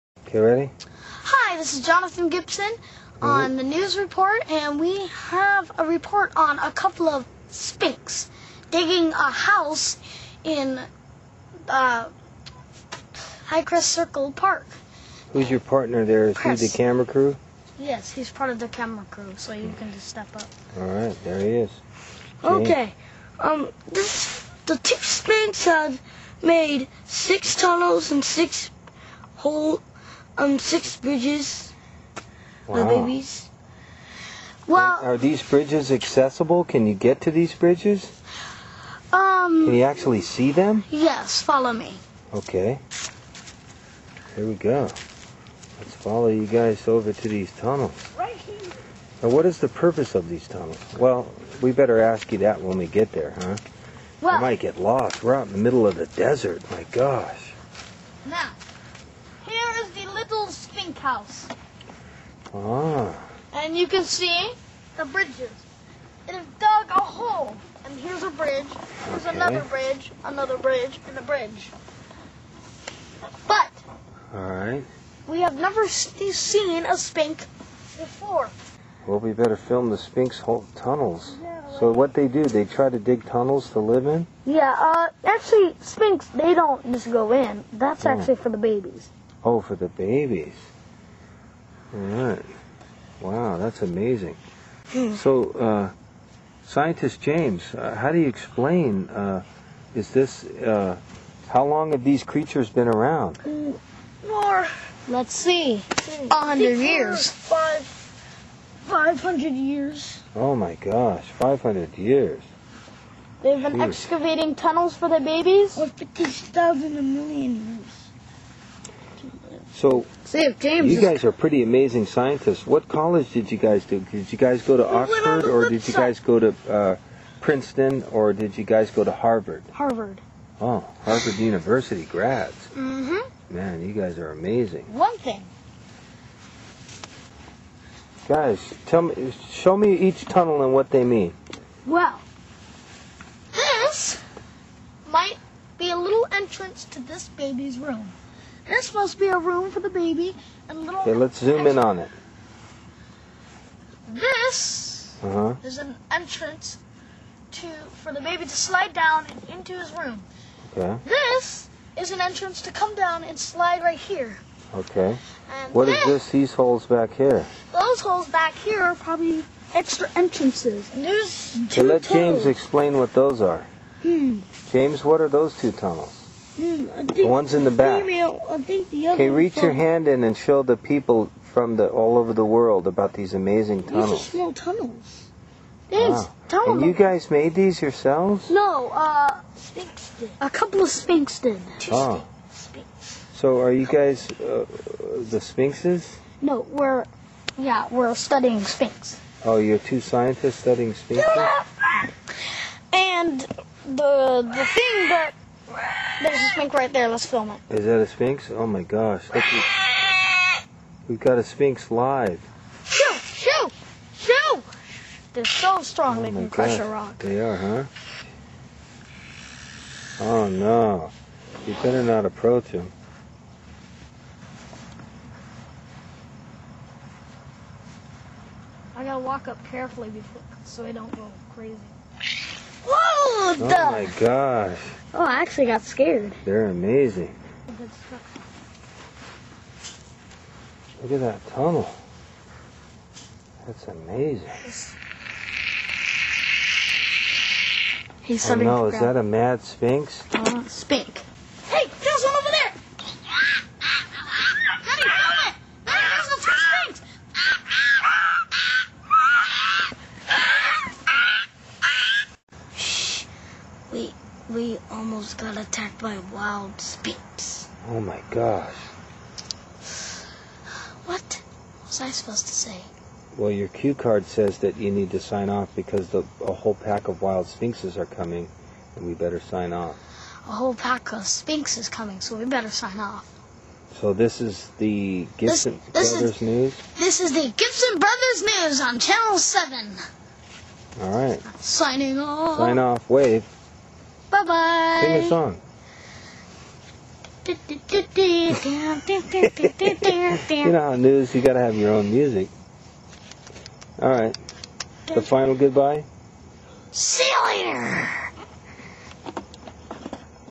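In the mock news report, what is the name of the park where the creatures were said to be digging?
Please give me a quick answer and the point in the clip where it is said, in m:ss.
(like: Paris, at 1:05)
Highcrest Circle Park, at 0:13.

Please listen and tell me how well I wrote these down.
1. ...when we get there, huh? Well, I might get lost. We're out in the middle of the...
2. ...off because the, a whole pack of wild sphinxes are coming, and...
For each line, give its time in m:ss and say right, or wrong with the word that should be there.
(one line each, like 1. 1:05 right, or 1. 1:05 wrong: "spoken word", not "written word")
1. 0:52 right
2. 4:35 right.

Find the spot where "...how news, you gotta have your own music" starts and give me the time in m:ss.
5:00.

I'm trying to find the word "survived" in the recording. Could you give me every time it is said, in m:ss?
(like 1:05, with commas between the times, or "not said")
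not said.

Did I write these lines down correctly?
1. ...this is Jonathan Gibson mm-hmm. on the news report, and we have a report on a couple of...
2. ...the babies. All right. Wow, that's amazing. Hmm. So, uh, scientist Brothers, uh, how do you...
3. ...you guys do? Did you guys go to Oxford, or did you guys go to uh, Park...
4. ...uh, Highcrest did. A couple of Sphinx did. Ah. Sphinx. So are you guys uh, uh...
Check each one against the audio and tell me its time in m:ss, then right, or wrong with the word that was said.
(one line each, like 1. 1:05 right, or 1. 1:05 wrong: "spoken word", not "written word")
1. 0:01 right
2. 1:29 wrong: "James", not "Brothers"
3. 2:03 wrong: "Princeton", not "Park"
4. 3:08 wrong: "Sphinx", not "Highcrest".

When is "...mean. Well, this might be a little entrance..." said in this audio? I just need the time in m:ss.
2:21.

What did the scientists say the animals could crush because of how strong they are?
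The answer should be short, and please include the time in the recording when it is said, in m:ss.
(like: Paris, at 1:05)
A rock, at 3:36.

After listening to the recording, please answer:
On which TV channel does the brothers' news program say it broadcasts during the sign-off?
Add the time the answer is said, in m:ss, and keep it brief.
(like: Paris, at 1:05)
Channel 7, at 4:48.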